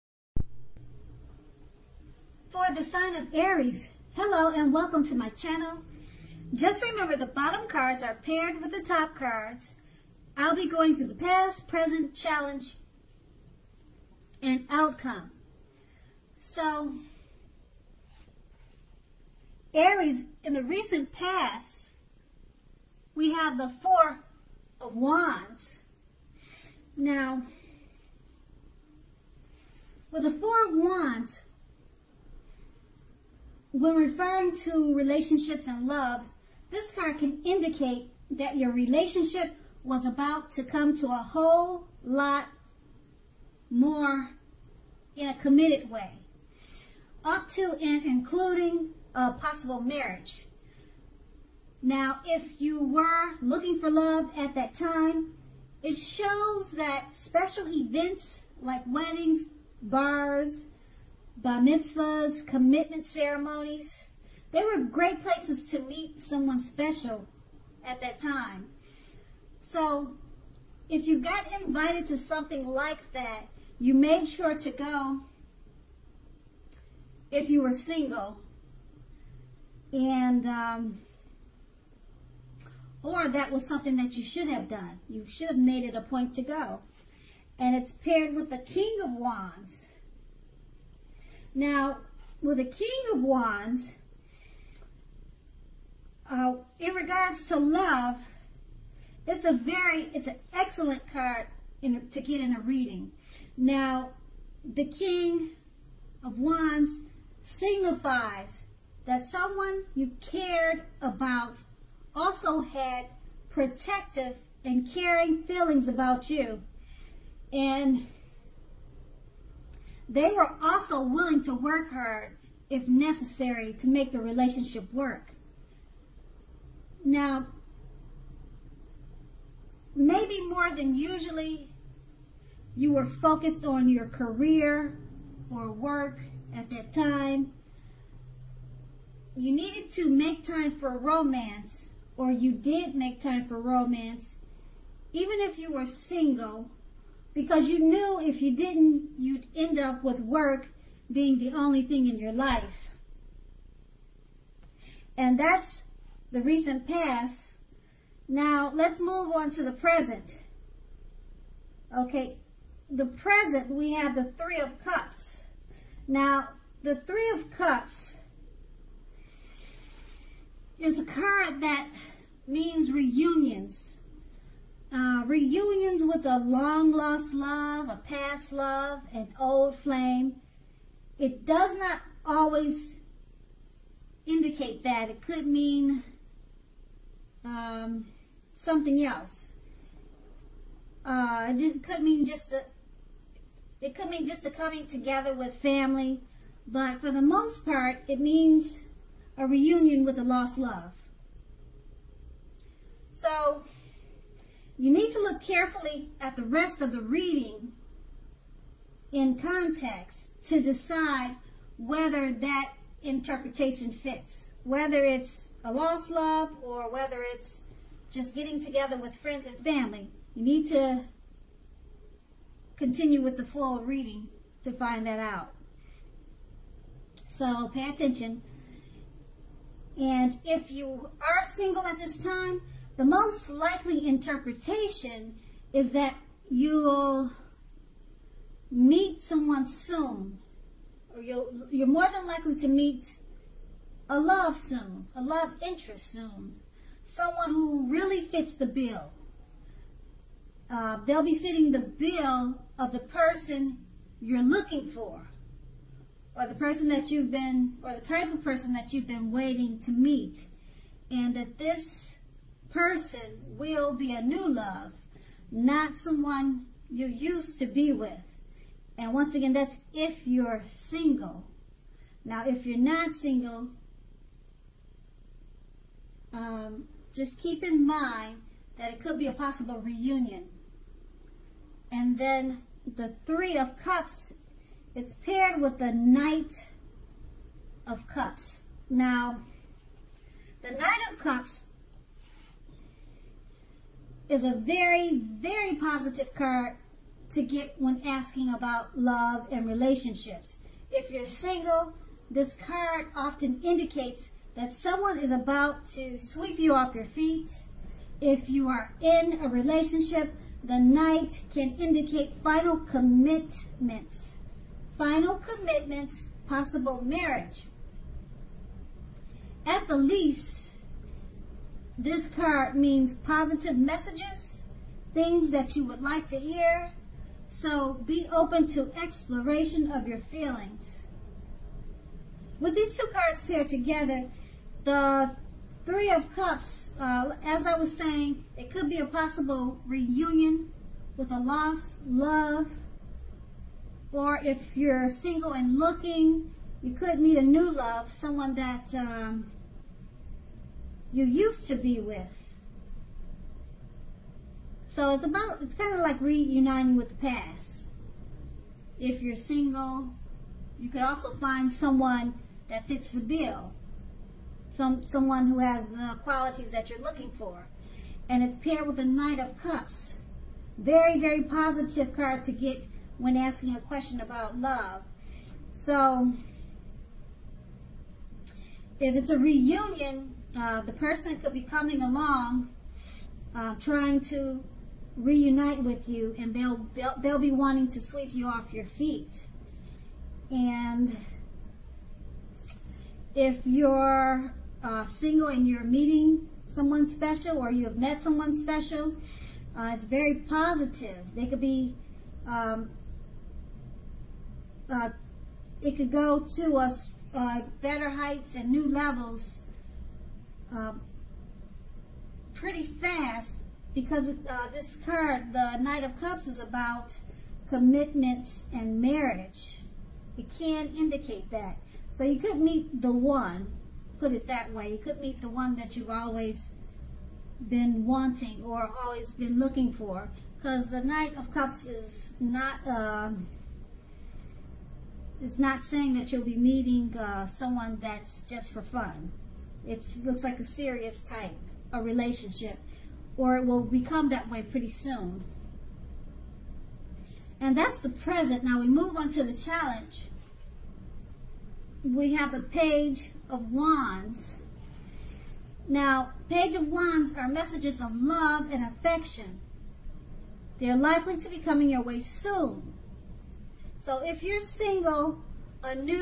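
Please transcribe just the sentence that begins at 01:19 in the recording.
And, um, or that was something that you should have done.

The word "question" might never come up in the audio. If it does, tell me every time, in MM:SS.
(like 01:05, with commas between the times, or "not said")
06:13.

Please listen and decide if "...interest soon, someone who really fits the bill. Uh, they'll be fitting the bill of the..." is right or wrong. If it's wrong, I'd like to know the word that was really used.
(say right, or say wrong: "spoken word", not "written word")
right.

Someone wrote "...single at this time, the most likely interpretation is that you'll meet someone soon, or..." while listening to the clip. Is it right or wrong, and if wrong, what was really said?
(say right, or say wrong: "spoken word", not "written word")
right.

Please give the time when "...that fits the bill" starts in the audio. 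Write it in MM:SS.
06:02.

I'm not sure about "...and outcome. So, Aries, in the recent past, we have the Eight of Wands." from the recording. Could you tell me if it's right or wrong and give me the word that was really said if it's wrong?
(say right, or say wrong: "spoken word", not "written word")
wrong: "Four", not "Eight".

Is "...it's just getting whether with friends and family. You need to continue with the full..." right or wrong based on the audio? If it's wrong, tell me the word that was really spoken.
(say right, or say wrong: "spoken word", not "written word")
wrong: "together", not "whether".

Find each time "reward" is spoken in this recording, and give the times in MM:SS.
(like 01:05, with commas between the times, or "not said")
not said.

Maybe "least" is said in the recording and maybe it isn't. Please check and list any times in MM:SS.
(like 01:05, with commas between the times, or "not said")
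05:19.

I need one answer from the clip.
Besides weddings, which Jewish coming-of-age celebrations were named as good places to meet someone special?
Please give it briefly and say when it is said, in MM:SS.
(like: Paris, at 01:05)
bar mitzvahs, at 01:01.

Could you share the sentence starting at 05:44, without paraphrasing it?
Or if you're single and looking, you could meet a new love, someone that um, you used to be with.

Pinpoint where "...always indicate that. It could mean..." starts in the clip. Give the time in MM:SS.
03:02.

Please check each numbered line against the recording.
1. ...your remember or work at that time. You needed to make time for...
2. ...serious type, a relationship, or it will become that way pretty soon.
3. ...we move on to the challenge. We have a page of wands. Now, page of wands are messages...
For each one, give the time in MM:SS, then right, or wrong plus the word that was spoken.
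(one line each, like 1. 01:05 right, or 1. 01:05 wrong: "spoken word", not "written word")
1. 02:13 wrong: "career", not "remember"
2. 07:20 right
3. 07:28 right.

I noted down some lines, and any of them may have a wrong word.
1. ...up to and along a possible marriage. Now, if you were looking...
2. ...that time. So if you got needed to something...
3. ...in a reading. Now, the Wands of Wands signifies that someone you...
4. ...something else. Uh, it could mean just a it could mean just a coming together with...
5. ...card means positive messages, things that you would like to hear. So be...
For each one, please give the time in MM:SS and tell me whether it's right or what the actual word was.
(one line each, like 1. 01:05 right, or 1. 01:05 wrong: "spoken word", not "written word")
1. 00:47 wrong: "including", not "along"
2. 01:08 wrong: "invited", not "needed"
3. 01:42 wrong: "King", not "Wands"
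4. 03:08 right
5. 05:22 right.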